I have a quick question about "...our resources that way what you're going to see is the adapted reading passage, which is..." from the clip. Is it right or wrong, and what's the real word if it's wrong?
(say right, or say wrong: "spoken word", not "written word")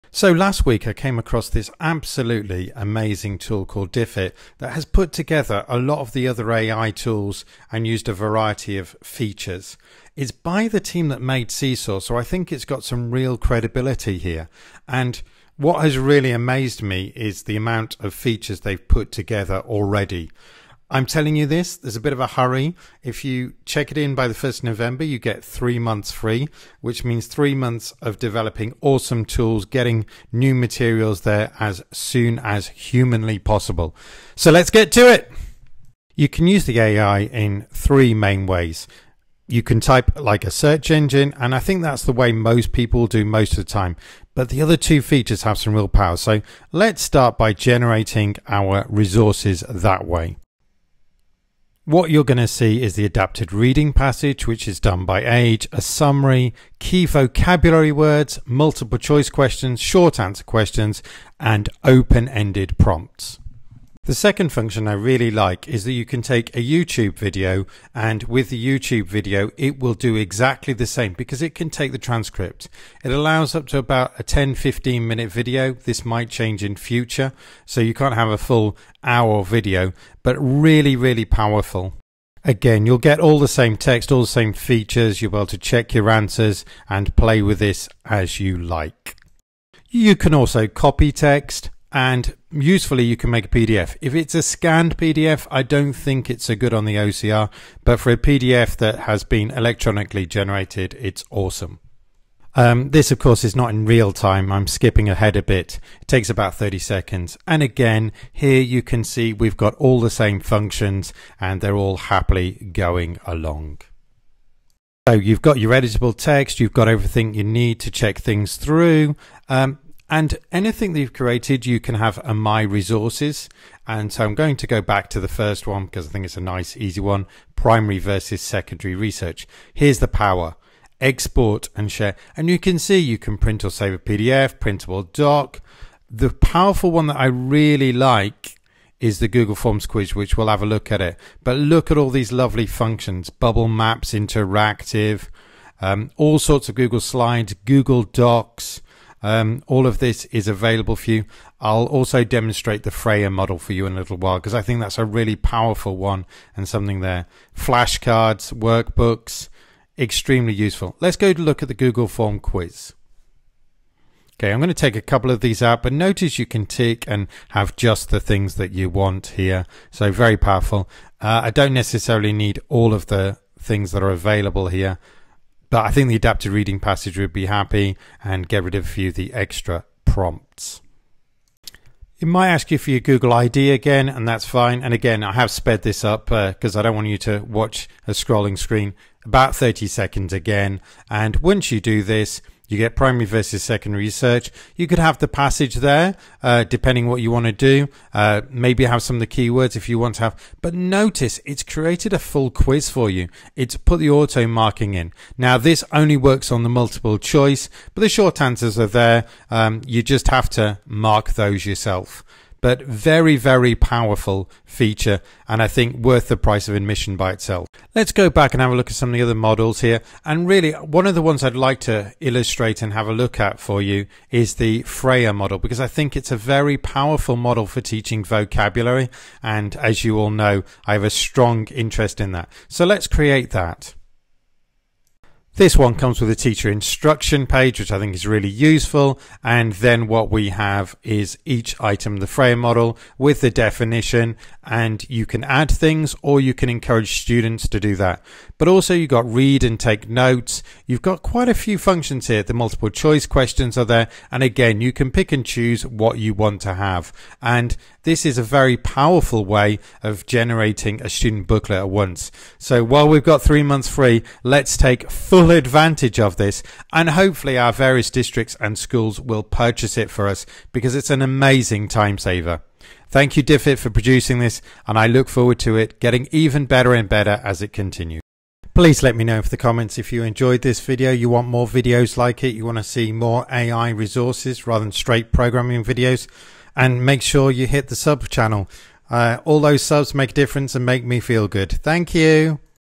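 right.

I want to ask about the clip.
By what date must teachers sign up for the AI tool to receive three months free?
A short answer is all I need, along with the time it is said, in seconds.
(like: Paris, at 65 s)
1st November, at 24 s.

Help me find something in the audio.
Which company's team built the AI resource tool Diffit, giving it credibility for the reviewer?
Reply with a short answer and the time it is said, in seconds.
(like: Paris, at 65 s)
Seesaw, at 11 s.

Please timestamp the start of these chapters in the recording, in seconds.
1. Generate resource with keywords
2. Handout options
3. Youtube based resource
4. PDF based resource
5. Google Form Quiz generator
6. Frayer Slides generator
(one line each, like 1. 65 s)
1. 37 s
2. 54 s
3. 64 s
4. 90 s
5. 132 s
6. 219 s.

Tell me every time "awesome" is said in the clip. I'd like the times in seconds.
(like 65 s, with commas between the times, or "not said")
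28 s, 101 s.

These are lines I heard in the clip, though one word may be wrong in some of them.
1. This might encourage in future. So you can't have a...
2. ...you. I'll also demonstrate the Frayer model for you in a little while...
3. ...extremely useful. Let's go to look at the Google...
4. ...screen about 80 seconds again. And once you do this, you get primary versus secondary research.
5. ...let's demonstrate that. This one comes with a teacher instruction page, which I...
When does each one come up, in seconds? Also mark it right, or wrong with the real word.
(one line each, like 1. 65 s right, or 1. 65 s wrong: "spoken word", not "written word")
1. 75 s wrong: "change", not "encourage"
2. 151 s right
3. 159 s right
4. 188 s wrong: "30", not "80"
5. 232 s wrong: "create", not "demonstrate".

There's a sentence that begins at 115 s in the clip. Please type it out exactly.
So you've got your editable text, you've got everything you need to check things through.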